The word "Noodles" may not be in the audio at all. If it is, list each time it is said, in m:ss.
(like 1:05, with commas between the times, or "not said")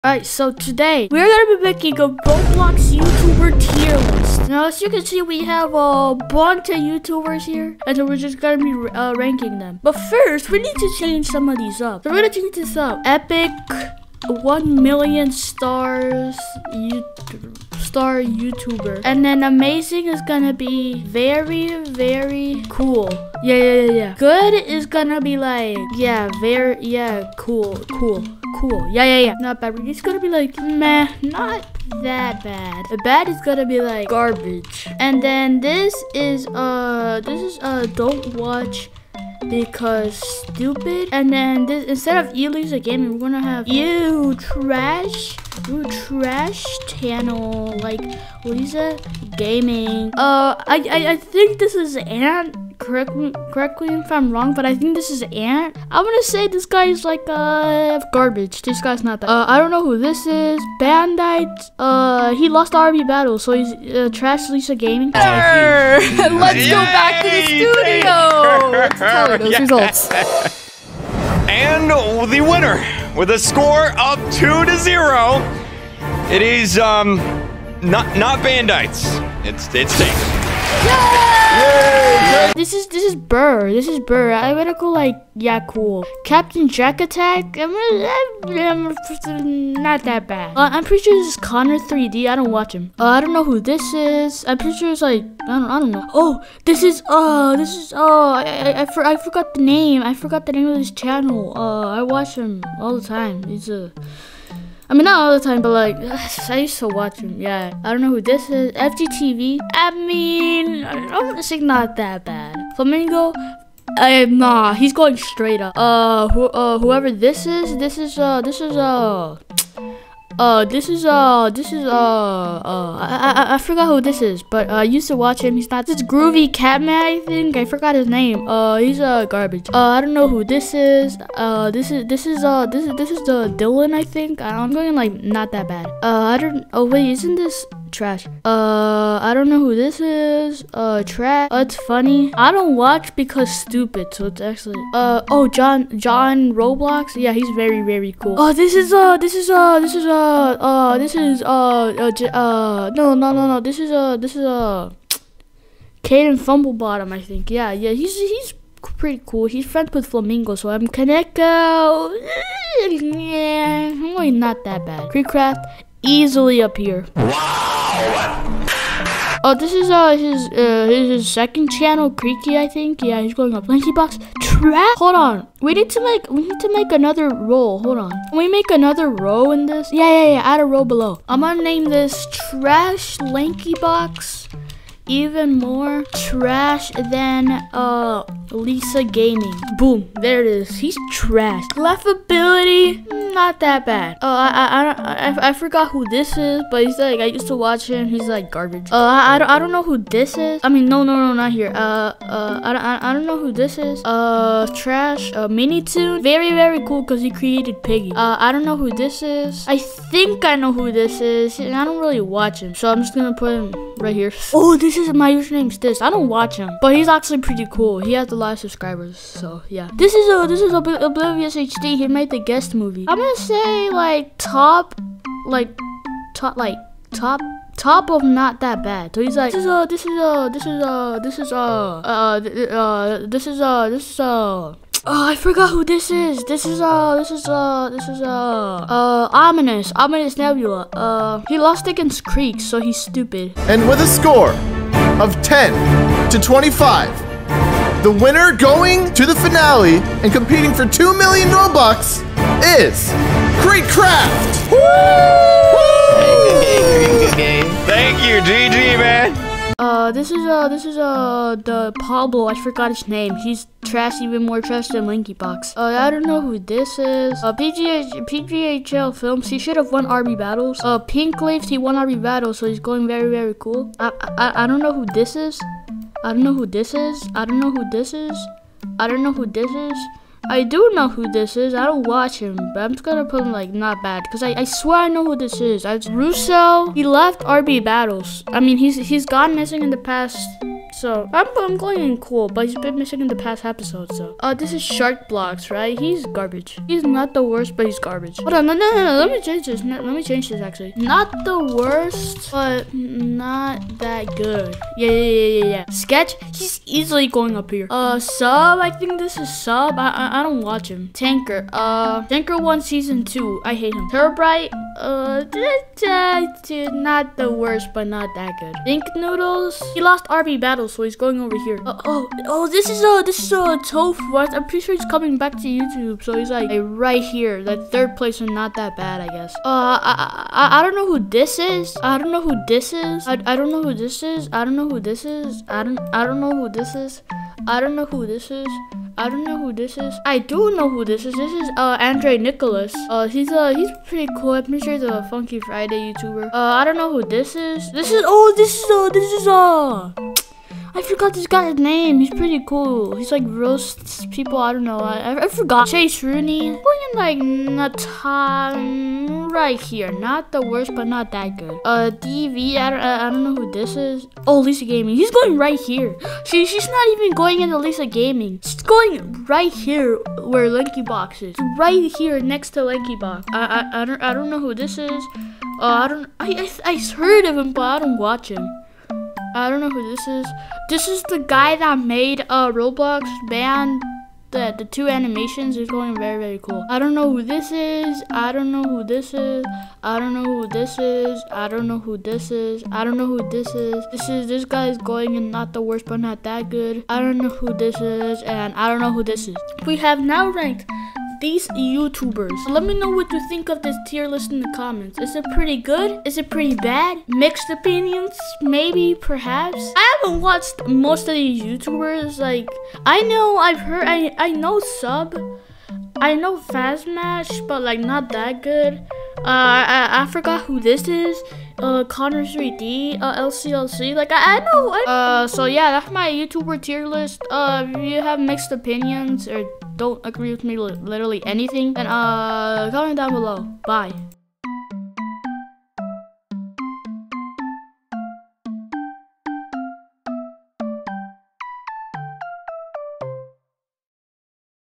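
5:19.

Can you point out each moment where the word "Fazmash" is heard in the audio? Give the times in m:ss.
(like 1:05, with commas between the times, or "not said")
6:56.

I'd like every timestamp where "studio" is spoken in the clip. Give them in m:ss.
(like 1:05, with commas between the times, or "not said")
1:07.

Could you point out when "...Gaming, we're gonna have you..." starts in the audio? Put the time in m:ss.
0:42.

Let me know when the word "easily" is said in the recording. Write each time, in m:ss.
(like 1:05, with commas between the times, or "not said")
2:46, 5:06.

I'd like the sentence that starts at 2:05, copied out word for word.
He's not this groovy cat man, I think.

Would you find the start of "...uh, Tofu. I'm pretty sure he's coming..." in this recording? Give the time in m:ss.
5:23.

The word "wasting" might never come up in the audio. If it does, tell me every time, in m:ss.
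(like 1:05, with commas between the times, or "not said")
not said.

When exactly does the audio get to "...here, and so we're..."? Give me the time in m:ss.
0:07.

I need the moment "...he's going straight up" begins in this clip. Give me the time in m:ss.
1:54.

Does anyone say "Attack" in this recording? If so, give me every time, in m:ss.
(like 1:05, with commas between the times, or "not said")
1:27.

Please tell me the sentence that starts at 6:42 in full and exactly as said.
Let me know what you think of this tier list in the comments.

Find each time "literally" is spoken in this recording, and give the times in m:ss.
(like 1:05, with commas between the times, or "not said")
7:10.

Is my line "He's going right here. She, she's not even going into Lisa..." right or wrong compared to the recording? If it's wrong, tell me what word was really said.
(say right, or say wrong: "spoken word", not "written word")
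right.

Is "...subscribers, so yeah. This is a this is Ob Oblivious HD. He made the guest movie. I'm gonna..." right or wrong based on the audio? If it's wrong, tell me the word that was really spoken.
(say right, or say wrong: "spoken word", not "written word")
right.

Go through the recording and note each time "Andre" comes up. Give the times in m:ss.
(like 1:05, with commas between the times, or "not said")
5:41.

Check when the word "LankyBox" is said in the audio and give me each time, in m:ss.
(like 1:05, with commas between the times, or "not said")
2:53, 3:03.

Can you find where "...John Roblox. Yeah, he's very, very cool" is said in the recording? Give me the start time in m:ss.
2:25.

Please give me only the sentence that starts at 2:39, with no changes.
He's friends with Flamingo, so I'm Kaneko.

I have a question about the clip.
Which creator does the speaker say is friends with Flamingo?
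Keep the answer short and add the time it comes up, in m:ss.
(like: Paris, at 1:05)
Caden Fumblebottom, at 2:36.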